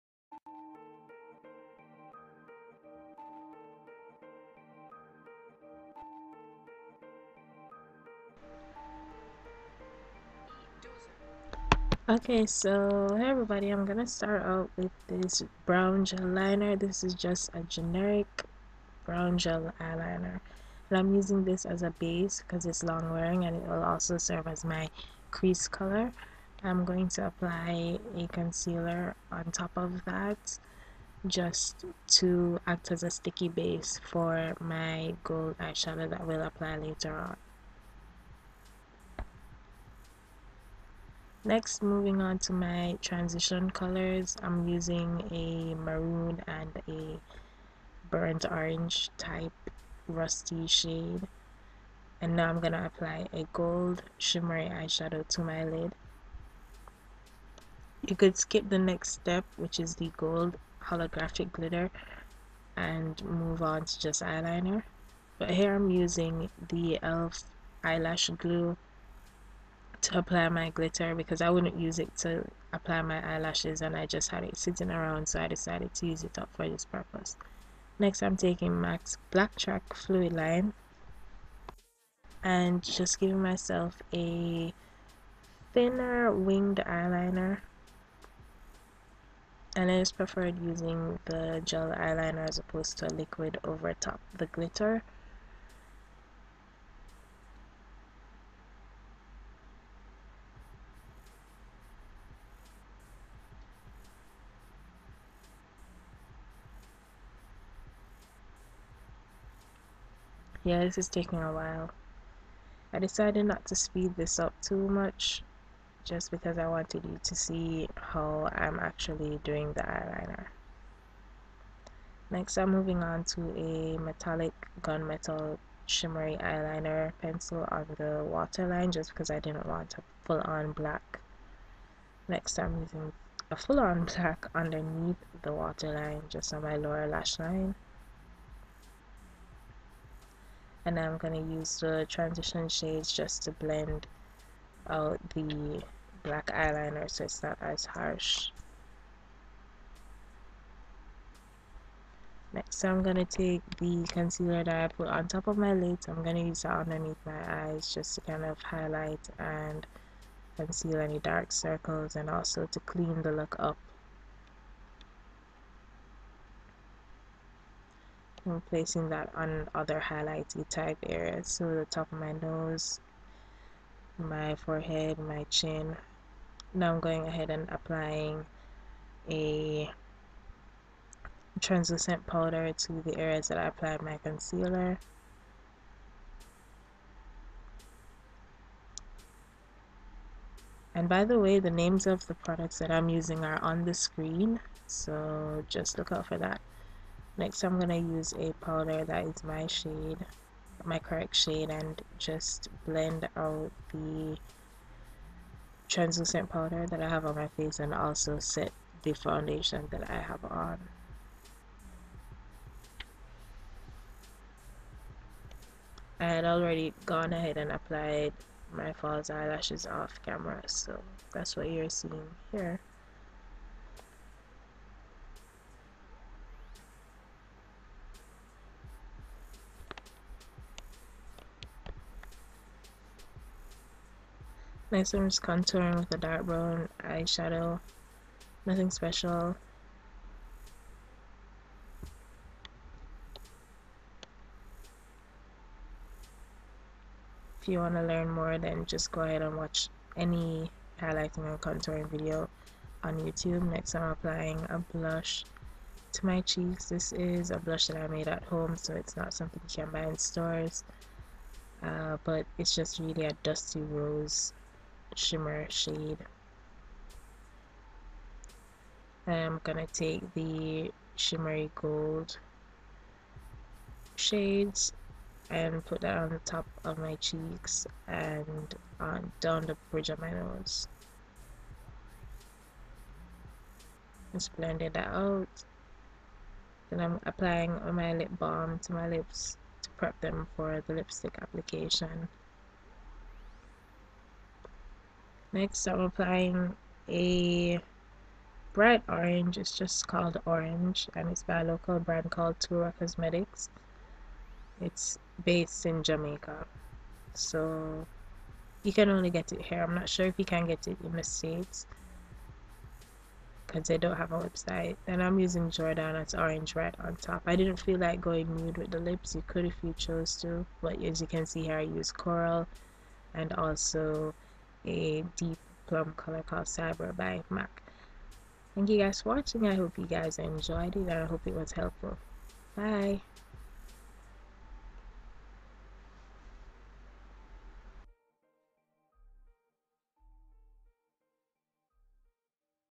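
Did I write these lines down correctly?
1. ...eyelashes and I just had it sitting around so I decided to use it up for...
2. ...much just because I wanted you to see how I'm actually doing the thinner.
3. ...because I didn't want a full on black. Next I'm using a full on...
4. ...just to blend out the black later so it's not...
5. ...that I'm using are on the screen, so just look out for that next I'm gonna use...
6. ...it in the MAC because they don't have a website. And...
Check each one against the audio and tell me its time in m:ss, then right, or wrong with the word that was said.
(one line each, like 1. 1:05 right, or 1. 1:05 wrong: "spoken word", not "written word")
1. 1:13 right
2. 1:54 wrong: "eyeliner", not "thinner"
3. 2:09 right
4. 2:23 wrong: "eyeliner", not "later"
5. 3:12 right
6. 5:10 wrong: "States", not "MAC".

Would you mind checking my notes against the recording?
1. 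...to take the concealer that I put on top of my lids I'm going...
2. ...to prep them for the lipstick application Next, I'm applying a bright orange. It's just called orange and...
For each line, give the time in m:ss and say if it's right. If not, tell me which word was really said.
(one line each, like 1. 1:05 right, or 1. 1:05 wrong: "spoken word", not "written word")
1. 2:33 right
2. 4:49 right.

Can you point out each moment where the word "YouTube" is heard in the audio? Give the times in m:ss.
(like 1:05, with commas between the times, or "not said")
4:13.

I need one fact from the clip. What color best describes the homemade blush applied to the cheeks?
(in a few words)
dusty rose shimmer.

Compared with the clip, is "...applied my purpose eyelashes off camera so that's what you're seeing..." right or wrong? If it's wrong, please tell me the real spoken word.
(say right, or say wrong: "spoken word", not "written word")
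wrong: "false", not "purpose".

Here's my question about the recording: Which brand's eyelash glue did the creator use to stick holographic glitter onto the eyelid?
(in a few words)
elf.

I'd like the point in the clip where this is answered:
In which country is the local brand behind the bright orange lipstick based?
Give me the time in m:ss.
5:06.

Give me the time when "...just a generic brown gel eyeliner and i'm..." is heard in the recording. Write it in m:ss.
0:17.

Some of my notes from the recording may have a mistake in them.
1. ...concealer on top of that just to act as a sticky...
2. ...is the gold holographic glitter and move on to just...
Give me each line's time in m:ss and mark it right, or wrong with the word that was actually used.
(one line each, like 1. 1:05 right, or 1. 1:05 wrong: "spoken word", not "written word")
1. 0:28 right
2. 0:59 right.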